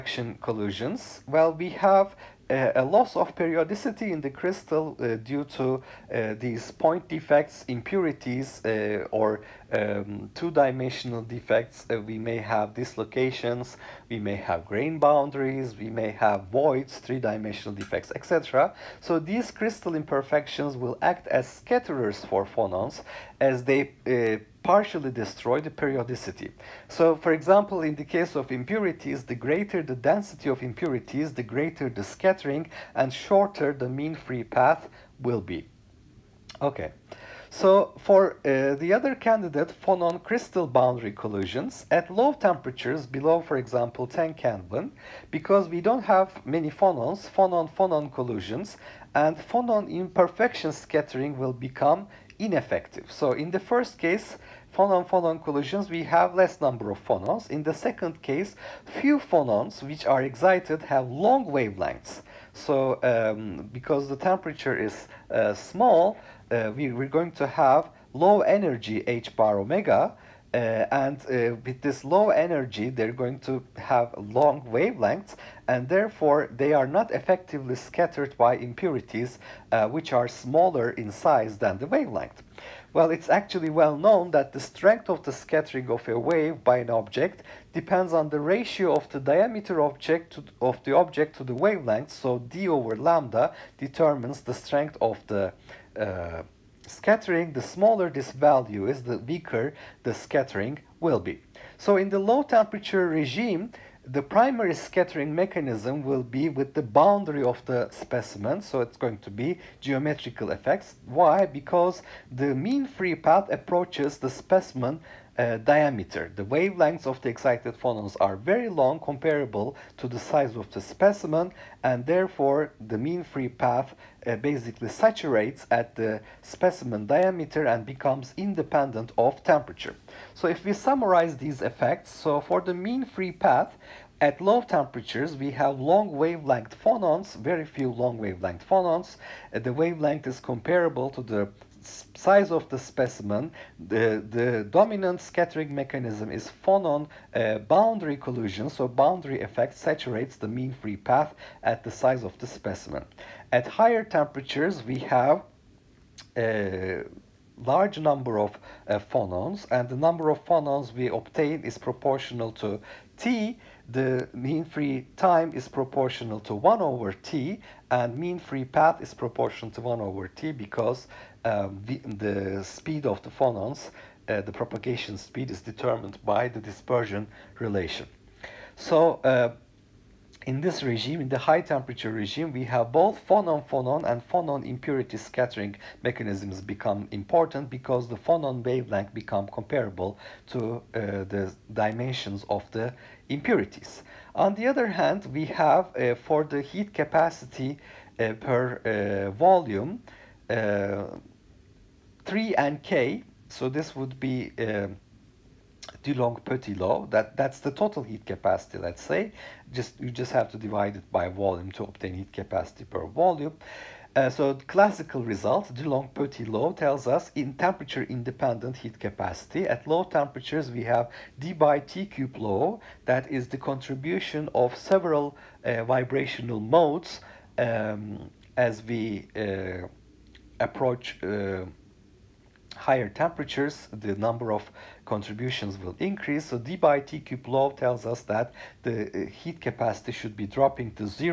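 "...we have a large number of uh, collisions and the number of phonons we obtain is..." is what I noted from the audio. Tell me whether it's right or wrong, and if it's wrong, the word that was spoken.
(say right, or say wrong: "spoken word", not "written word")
wrong: "phonons", not "collisions".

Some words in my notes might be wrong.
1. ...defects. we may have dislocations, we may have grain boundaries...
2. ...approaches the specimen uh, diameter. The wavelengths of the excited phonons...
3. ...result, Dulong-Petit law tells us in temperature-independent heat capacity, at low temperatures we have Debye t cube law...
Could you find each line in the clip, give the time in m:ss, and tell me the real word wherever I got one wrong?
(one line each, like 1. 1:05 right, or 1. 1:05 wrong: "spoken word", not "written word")
1. 0:11 right
2. 1:53 right
3. 3:35 right.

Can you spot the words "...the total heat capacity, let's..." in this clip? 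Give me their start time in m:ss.
3:27.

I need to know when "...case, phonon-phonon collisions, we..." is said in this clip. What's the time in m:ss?
0:53.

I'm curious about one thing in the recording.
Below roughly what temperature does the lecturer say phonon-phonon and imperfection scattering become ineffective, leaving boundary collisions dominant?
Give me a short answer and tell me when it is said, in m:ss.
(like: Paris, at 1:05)
10 Kelvin, at 0:44.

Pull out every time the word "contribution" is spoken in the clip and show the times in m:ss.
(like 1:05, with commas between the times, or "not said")
3:43, 3:55.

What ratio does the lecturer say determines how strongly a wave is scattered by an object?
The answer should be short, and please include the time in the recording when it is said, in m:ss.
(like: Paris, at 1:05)
d over lambda, at 1:32.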